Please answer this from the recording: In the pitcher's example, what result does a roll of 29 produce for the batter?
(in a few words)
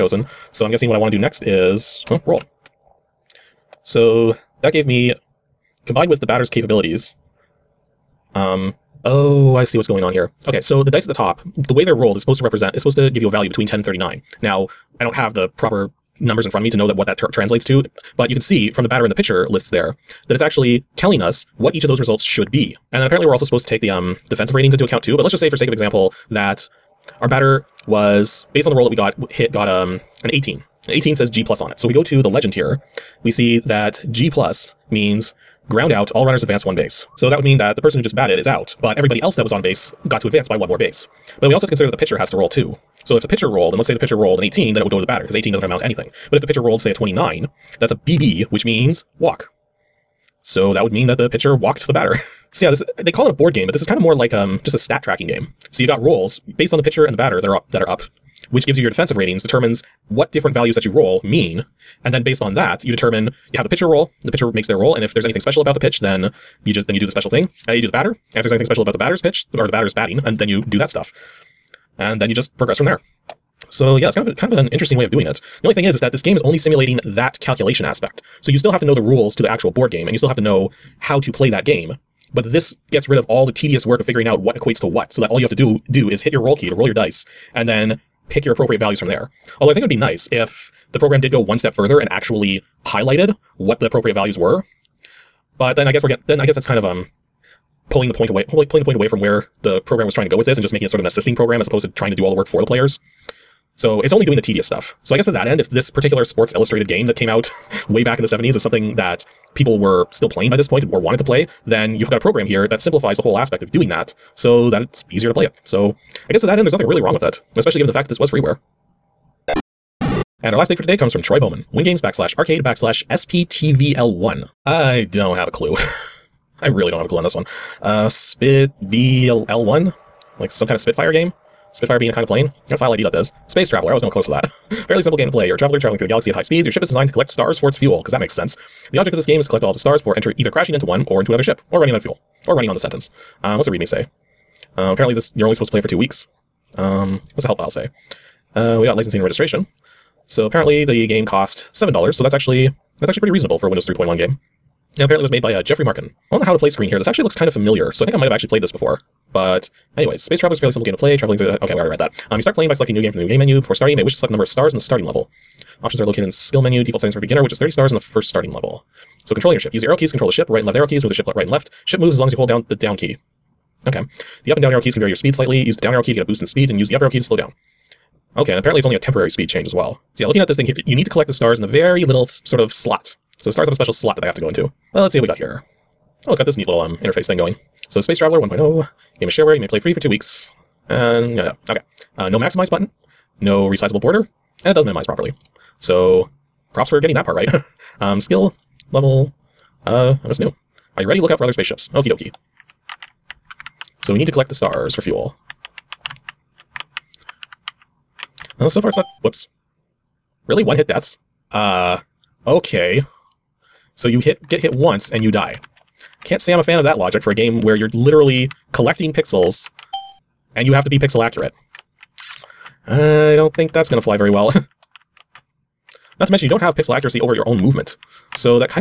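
Walk.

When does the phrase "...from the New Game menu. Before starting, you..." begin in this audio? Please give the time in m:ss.
2:43.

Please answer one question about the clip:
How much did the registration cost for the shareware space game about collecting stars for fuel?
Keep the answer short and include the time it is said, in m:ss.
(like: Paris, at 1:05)
$7, at 2:31.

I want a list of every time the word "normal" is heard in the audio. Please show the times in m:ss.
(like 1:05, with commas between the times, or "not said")
not said.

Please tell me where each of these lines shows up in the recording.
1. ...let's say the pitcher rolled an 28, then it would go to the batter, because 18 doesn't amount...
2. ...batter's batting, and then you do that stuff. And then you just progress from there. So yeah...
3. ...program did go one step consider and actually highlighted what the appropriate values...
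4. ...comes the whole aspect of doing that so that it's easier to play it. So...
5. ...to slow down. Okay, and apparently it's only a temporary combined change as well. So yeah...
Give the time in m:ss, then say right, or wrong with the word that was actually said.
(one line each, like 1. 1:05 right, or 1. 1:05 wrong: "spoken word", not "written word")
1. 0:43 wrong: "18", not "28"
2. 1:09 right
3. 1:30 wrong: "further", not "consider"
4. 1:52 wrong: "simplifies", not "comes"
5. 2:57 wrong: "speed", not "combined".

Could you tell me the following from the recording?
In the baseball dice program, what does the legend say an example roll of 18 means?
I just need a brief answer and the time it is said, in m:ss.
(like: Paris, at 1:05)
Ground out, all runners advance one base, at 0:35.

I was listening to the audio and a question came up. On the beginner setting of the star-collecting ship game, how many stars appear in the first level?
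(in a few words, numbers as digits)
30.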